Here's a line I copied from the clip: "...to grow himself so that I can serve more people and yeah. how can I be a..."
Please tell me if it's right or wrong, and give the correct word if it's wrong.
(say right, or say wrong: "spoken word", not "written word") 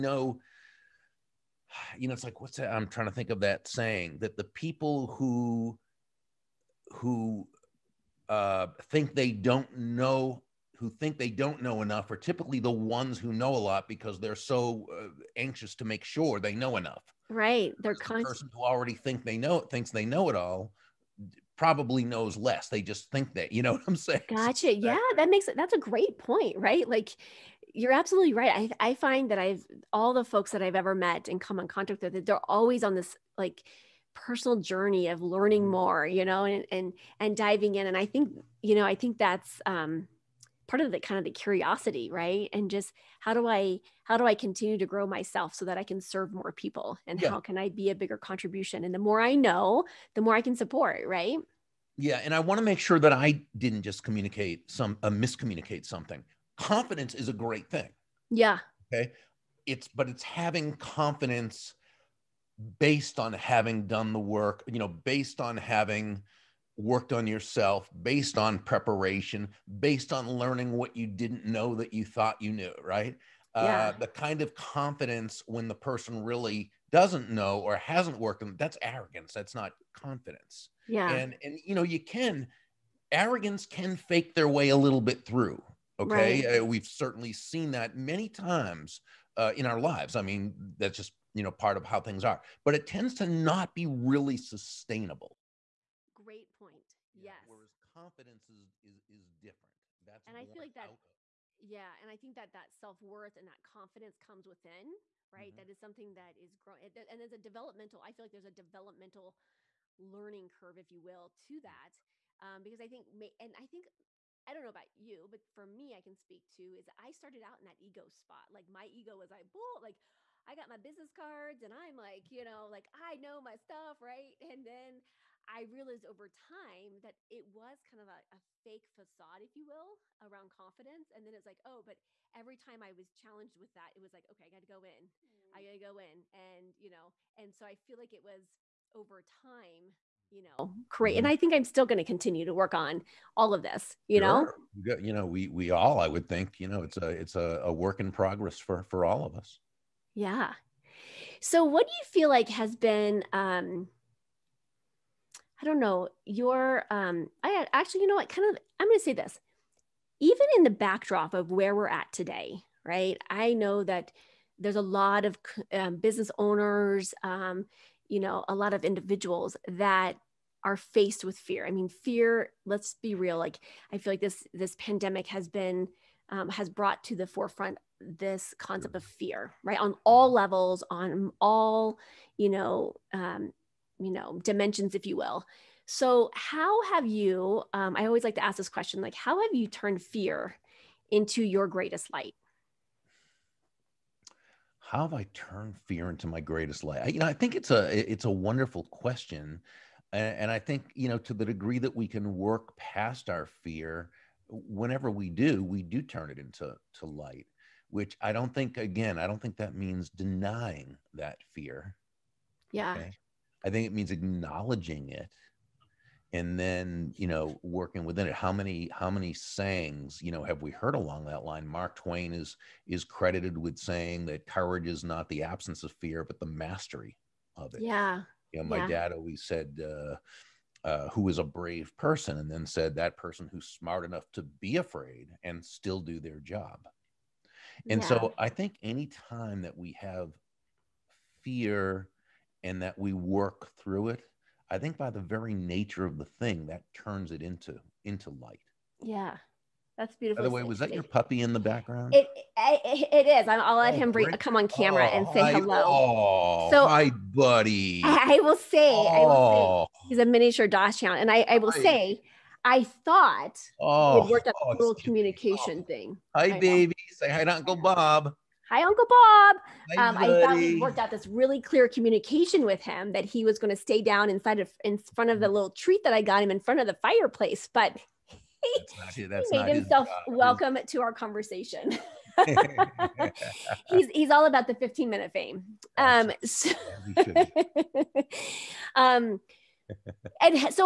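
wrong: "myself", not "himself".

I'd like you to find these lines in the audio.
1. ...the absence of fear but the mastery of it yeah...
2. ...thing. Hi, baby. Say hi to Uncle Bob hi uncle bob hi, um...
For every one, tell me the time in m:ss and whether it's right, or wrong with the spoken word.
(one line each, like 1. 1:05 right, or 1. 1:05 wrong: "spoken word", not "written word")
1. 3:45 right
2. 4:25 right.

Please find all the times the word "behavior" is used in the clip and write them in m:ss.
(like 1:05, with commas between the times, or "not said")
not said.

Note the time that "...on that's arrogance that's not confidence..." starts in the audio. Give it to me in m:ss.
1:18.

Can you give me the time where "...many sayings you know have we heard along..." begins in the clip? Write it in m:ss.
3:39.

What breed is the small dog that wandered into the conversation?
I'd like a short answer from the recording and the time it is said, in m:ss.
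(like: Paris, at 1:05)
Miniature Dachshund, at 4:20.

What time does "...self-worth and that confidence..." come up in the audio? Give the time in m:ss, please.
1:42.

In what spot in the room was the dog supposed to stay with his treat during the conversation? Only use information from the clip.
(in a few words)
In front of the fireplace.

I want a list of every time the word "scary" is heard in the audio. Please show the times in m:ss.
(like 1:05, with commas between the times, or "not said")
not said.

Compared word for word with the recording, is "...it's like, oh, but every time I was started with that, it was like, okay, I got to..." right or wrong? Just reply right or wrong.
wrong.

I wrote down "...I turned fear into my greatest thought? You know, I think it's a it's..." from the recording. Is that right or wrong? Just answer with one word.
wrong.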